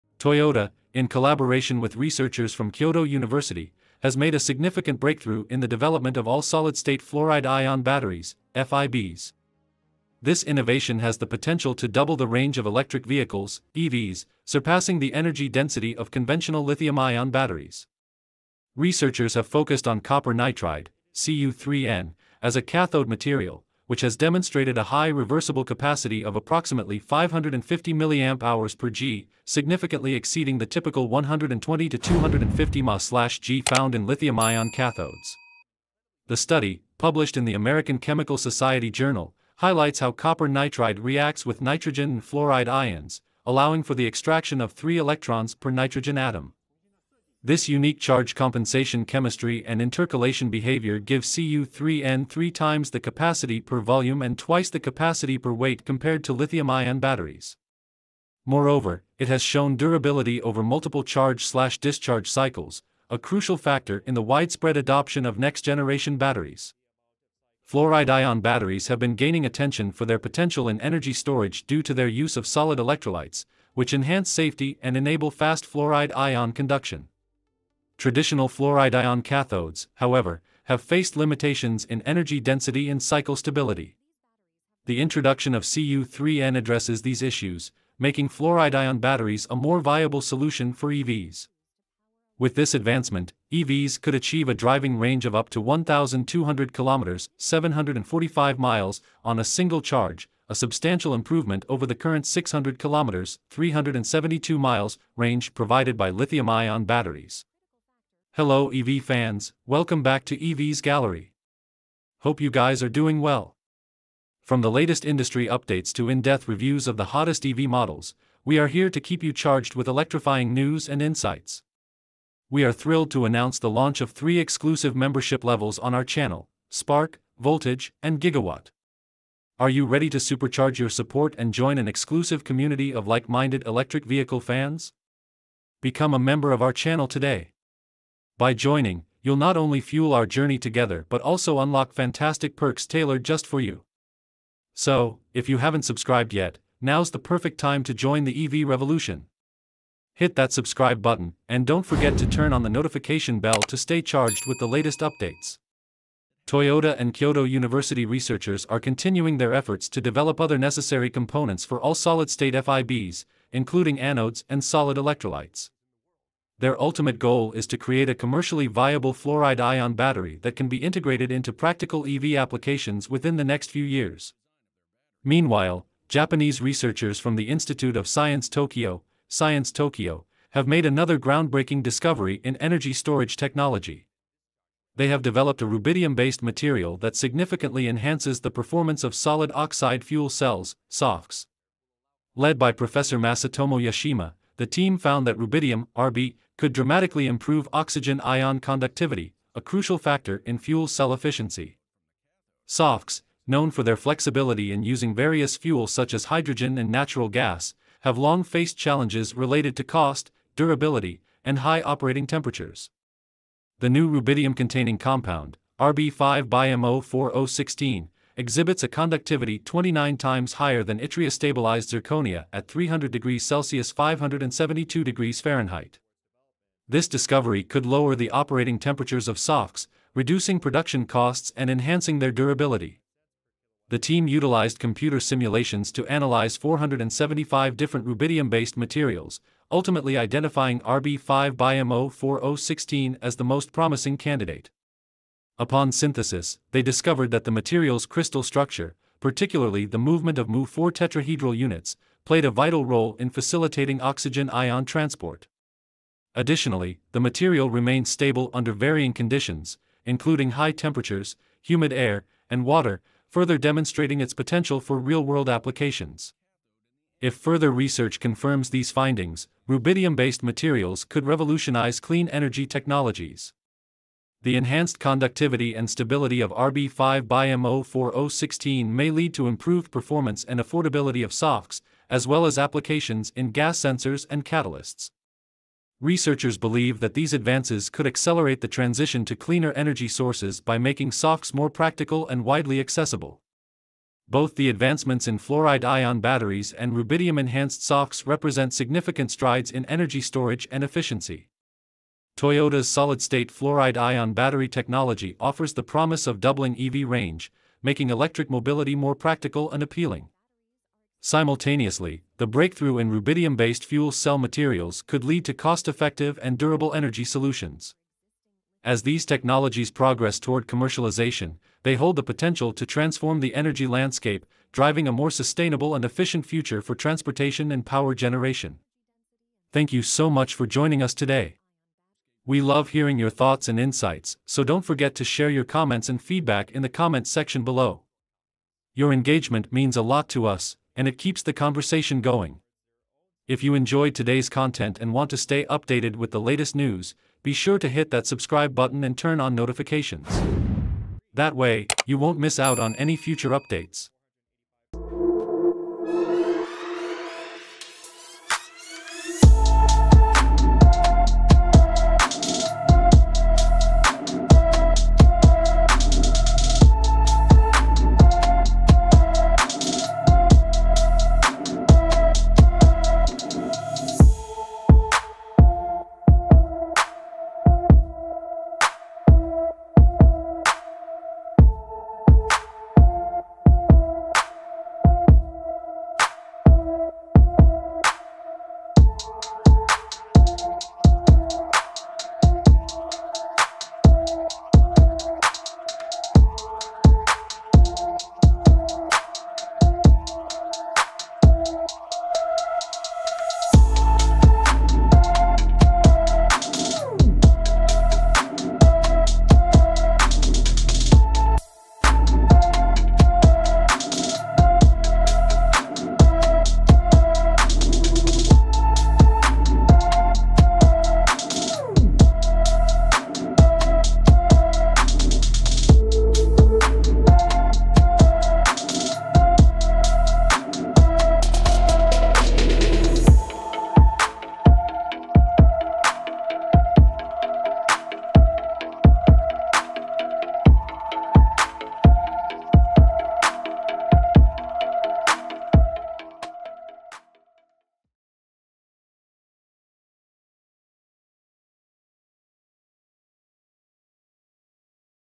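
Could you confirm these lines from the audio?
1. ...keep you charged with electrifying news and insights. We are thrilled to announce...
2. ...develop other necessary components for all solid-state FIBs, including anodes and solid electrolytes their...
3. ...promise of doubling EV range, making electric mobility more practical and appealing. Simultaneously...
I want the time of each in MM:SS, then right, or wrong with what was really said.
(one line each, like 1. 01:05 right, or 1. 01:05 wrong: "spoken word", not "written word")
1. 01:59 right
2. 02:40 right
3. 05:05 right.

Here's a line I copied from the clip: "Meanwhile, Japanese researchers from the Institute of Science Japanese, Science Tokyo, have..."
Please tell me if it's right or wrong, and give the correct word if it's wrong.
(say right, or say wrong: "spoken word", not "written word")
wrong: "Tokyo", not "Japanese".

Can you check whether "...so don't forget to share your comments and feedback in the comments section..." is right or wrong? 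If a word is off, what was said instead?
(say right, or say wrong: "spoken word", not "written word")
right.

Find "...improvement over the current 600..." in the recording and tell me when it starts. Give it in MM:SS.
01:41.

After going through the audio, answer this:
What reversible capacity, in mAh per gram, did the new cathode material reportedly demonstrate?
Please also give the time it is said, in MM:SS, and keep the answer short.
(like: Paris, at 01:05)
550, at 00:26.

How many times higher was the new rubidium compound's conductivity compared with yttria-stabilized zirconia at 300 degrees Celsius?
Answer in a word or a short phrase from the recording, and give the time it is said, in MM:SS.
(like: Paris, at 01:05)
29, at 03:39.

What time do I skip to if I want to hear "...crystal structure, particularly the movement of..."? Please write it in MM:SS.
04:08.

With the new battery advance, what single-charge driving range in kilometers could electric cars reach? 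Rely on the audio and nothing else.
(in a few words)
1,200 kilometers.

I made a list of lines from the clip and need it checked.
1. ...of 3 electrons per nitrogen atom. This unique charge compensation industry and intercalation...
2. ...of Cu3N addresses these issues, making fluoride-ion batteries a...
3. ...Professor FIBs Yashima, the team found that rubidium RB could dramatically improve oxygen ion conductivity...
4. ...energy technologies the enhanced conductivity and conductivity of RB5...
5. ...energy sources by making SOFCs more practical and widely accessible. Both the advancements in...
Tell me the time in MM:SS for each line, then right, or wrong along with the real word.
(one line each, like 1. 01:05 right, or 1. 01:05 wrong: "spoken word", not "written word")
1. 00:44 wrong: "chemistry", not "industry"
2. 01:25 right
3. 03:12 wrong: "Masatomo", not "FIBs"
4. 04:32 wrong: "stability", not "conductivity"
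5. 04:49 right.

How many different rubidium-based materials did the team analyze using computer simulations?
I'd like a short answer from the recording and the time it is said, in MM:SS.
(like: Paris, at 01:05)
475, at 03:56.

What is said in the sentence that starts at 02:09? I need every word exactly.
Are you ready to supercharge your support and join an exclusive community of like-minded electric vehicle fans?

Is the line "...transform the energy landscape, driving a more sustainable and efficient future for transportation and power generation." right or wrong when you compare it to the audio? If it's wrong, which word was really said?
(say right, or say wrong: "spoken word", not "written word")
right.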